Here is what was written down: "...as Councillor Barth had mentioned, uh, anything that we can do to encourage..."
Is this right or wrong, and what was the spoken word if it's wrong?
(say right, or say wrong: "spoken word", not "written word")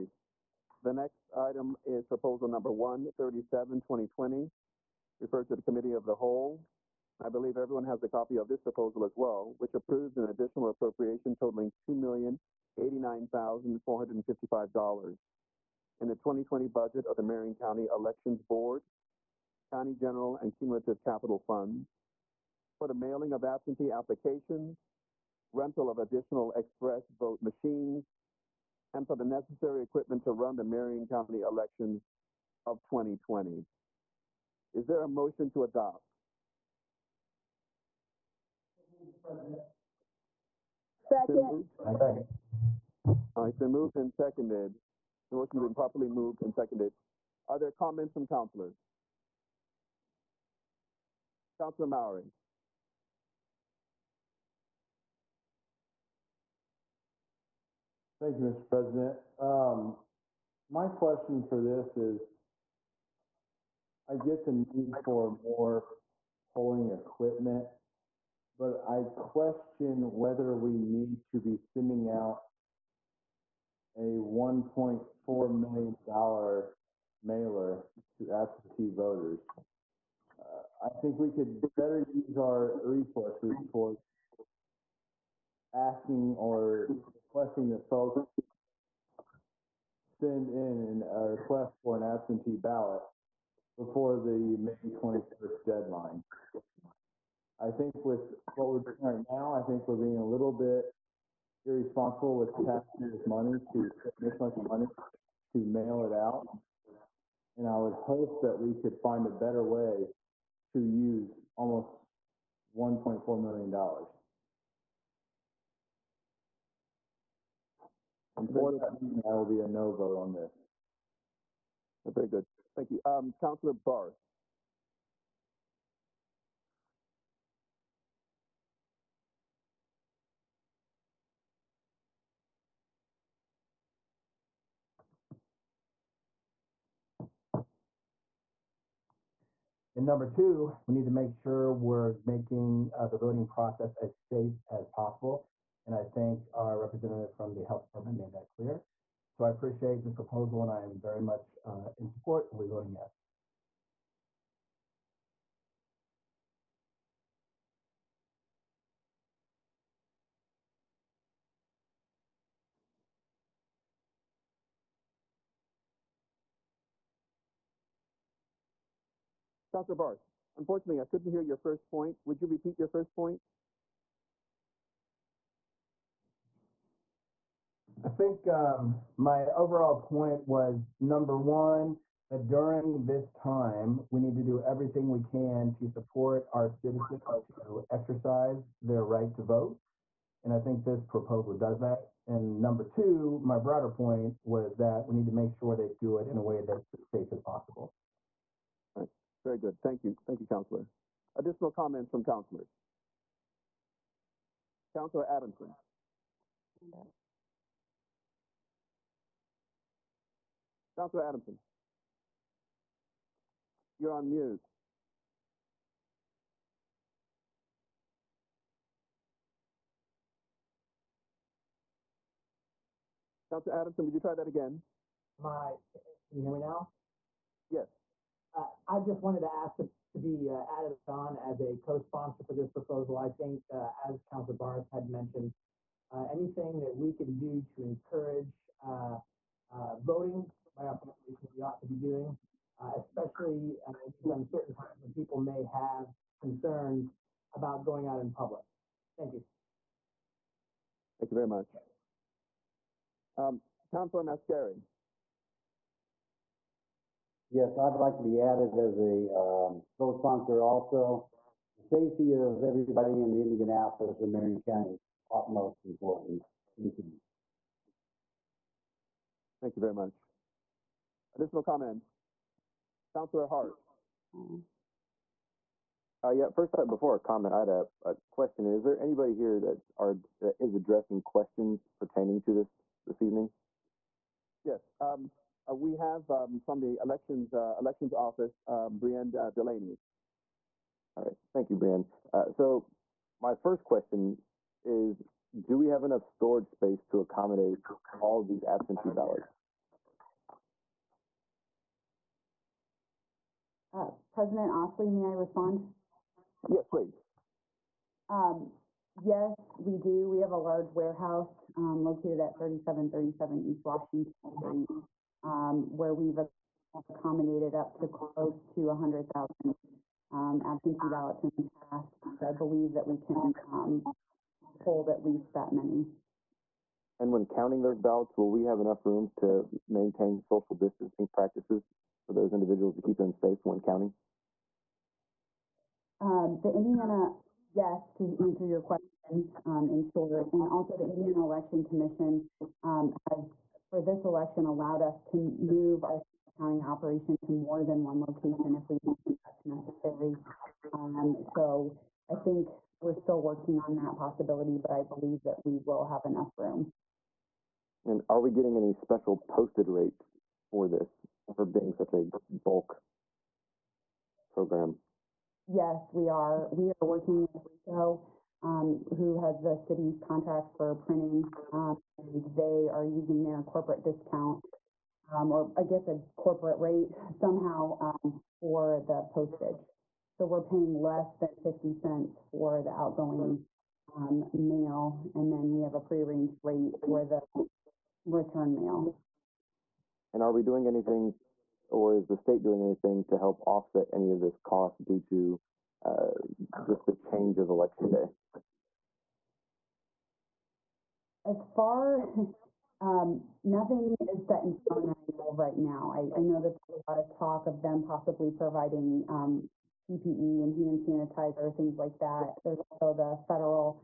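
right.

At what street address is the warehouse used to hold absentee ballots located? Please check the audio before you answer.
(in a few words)
3737 East Washington Street.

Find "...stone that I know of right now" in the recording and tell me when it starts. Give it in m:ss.
6:44.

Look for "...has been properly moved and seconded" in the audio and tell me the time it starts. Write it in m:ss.
0:45.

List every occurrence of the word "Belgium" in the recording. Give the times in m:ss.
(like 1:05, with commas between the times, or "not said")
not said.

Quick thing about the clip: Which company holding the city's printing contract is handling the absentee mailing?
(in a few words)
Ricoh.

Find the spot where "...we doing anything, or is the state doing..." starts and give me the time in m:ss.
6:30.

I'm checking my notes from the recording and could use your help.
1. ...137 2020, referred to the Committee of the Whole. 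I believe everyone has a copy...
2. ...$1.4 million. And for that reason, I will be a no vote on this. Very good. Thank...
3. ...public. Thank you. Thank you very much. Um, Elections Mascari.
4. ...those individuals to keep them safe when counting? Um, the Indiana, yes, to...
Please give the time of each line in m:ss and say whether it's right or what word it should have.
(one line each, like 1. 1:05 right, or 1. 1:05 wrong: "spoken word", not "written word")
1. 0:02 right
2. 1:52 right
3. 4:08 wrong: "Councilor", not "Elections"
4. 5:32 right.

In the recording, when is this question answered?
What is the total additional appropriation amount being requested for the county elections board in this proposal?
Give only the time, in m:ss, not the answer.
0:11.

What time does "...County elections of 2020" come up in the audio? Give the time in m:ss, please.
0:31.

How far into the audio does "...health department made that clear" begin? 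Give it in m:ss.
2:27.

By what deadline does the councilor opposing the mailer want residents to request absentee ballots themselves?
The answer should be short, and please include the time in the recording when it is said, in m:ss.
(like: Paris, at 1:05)
May 21st, at 1:34.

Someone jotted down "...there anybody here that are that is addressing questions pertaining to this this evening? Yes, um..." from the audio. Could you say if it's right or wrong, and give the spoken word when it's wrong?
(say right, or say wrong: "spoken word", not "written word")
right.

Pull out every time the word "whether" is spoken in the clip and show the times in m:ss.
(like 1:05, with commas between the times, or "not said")
1:10.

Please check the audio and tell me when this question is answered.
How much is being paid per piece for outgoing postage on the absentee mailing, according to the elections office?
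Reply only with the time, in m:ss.
6:21.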